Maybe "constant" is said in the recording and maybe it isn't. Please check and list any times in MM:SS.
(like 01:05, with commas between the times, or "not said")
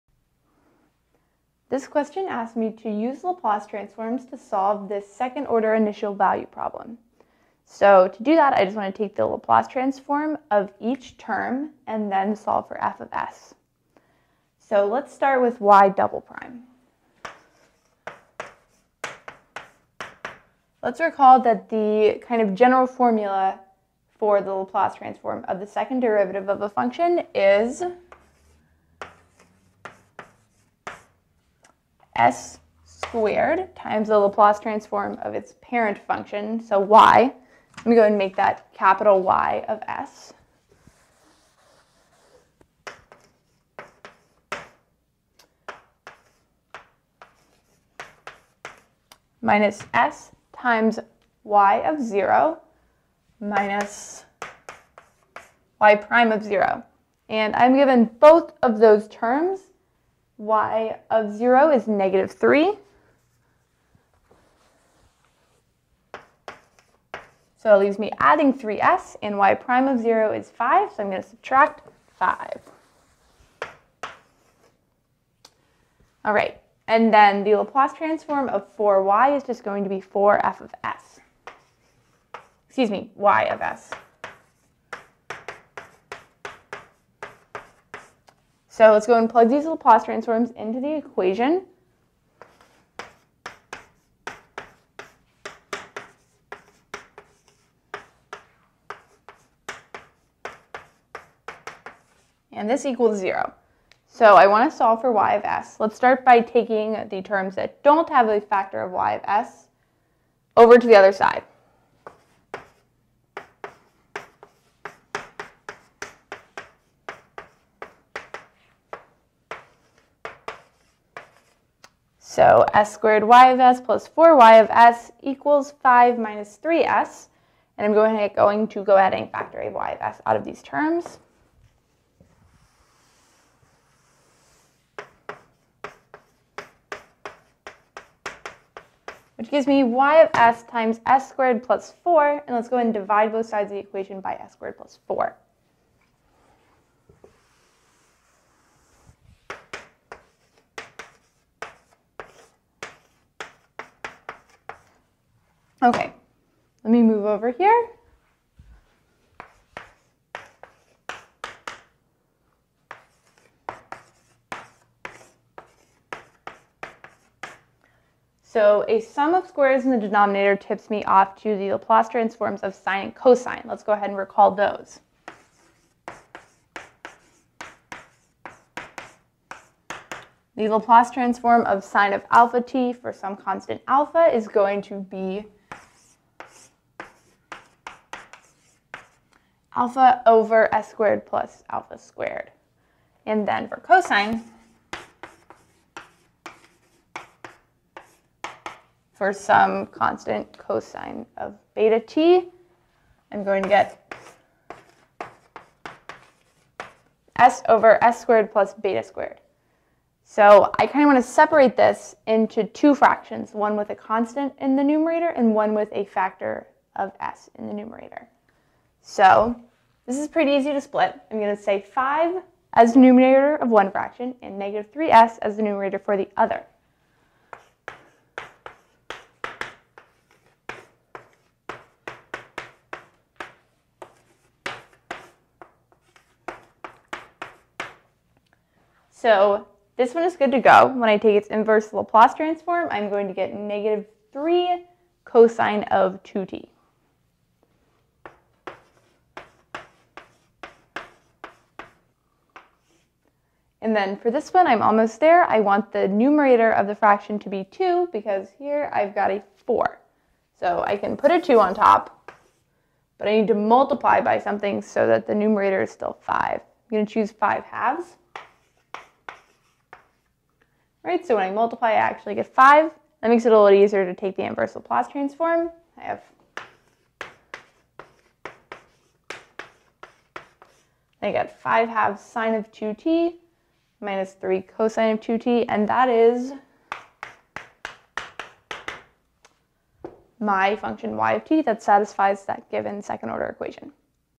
03:03, 03:19, 03:33.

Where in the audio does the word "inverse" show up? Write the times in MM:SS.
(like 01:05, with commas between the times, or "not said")
04:01, 04:34.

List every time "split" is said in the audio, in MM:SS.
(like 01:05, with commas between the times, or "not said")
03:40.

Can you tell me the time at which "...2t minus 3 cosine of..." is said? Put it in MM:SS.
04:42.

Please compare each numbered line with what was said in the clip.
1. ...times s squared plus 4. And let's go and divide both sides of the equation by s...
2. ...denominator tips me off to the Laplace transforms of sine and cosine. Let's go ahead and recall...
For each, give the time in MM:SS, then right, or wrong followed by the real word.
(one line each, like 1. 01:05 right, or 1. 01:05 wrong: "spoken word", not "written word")
1. 02:20 right
2. 02:49 right.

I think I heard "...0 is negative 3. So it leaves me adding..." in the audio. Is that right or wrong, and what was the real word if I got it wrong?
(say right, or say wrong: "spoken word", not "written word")
right.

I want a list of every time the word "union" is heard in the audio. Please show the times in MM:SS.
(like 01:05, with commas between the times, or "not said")
not said.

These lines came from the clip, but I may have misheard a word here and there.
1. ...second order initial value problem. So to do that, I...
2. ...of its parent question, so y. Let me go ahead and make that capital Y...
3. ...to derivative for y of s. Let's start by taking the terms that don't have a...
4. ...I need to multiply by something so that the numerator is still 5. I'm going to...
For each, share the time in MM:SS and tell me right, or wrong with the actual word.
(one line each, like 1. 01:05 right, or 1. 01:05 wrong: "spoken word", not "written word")
1. 00:05 right
2. 00:35 wrong: "function", not "question"
3. 01:44 wrong: "solve", not "derivative"
4. 04:23 right.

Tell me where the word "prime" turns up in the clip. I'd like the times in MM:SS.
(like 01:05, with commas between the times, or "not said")
00:16, 00:55, 01:09.